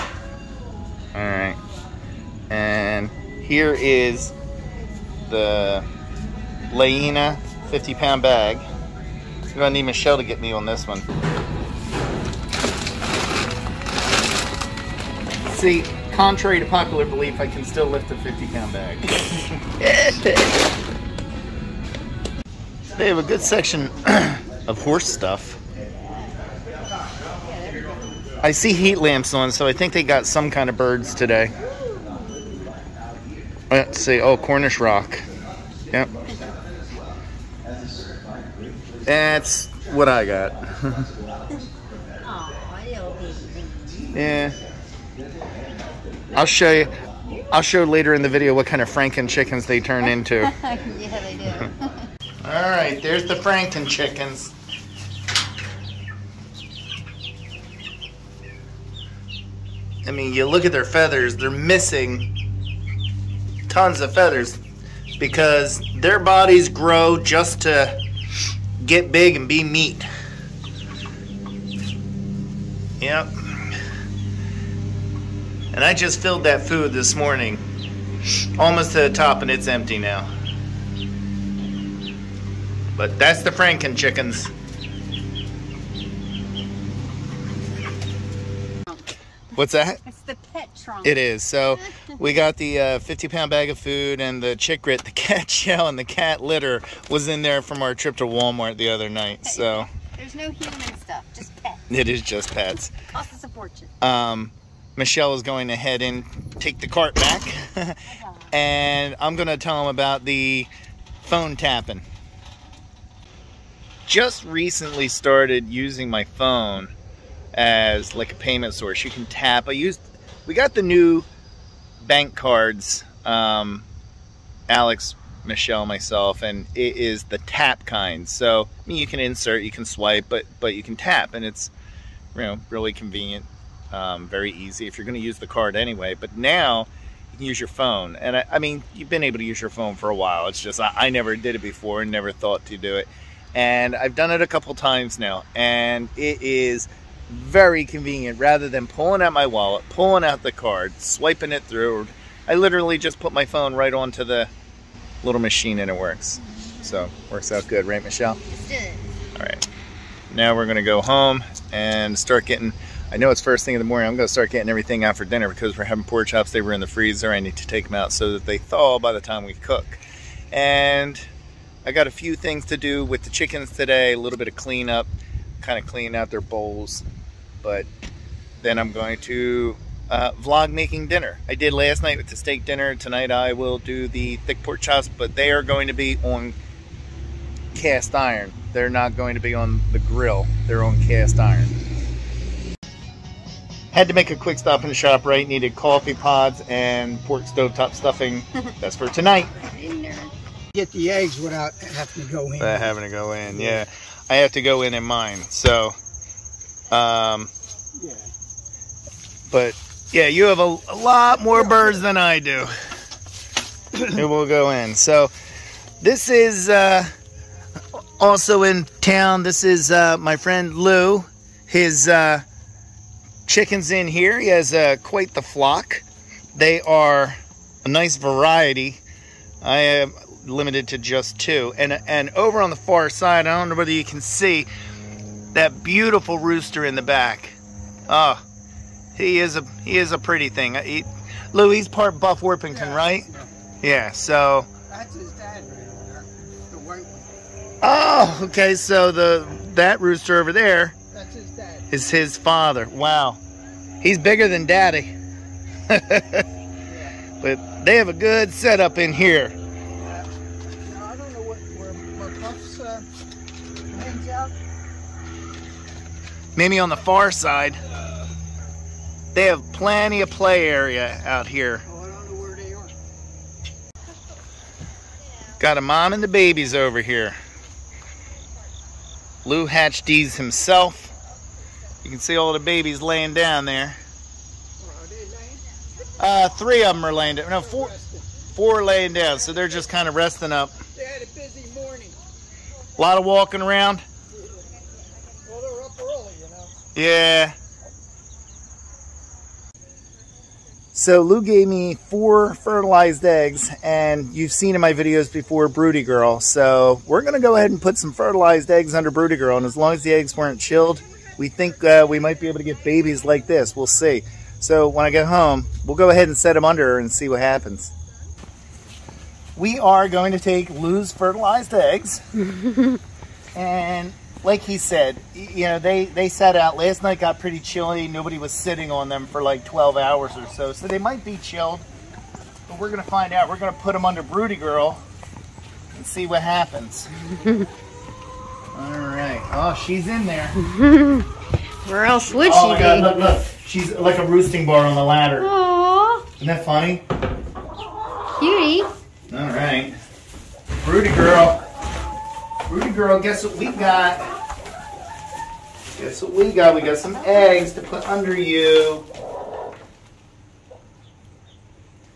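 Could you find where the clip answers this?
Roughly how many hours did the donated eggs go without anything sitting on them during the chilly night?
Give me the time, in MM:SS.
05:29.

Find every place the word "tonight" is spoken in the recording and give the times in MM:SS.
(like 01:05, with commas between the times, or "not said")
03:02, 03:19.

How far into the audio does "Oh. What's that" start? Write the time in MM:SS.
01:28.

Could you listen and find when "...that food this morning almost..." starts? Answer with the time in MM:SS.
01:16.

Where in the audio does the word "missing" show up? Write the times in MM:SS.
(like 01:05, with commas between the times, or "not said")
01:01.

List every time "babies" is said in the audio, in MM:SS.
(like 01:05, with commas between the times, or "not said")
04:36, 04:42, 05:12.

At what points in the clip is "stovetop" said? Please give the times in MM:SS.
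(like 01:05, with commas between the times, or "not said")
03:17.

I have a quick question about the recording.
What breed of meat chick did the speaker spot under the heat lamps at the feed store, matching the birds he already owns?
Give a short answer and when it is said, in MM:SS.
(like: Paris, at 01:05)
Cornish rock, at 00:34.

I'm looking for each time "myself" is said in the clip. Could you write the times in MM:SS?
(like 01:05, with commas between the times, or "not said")
02:05.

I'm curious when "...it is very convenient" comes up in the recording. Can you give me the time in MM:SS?
02:26.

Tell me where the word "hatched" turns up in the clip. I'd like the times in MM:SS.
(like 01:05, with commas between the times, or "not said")
04:39.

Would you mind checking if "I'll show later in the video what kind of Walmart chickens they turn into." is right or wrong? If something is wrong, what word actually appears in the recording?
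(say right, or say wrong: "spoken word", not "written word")
wrong: "Franken", not "Walmart".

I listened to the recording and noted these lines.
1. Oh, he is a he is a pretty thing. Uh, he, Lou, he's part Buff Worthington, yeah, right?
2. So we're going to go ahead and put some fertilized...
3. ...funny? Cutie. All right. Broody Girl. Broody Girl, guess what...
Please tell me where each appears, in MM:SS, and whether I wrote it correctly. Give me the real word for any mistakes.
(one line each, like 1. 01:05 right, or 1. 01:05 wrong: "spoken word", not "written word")
1. 03:58 right
2. 05:06 right
3. 05:46 right.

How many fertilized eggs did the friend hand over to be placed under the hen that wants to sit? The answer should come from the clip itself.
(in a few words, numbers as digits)
4.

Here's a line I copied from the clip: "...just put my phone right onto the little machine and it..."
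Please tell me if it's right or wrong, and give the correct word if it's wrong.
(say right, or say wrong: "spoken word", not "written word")
right.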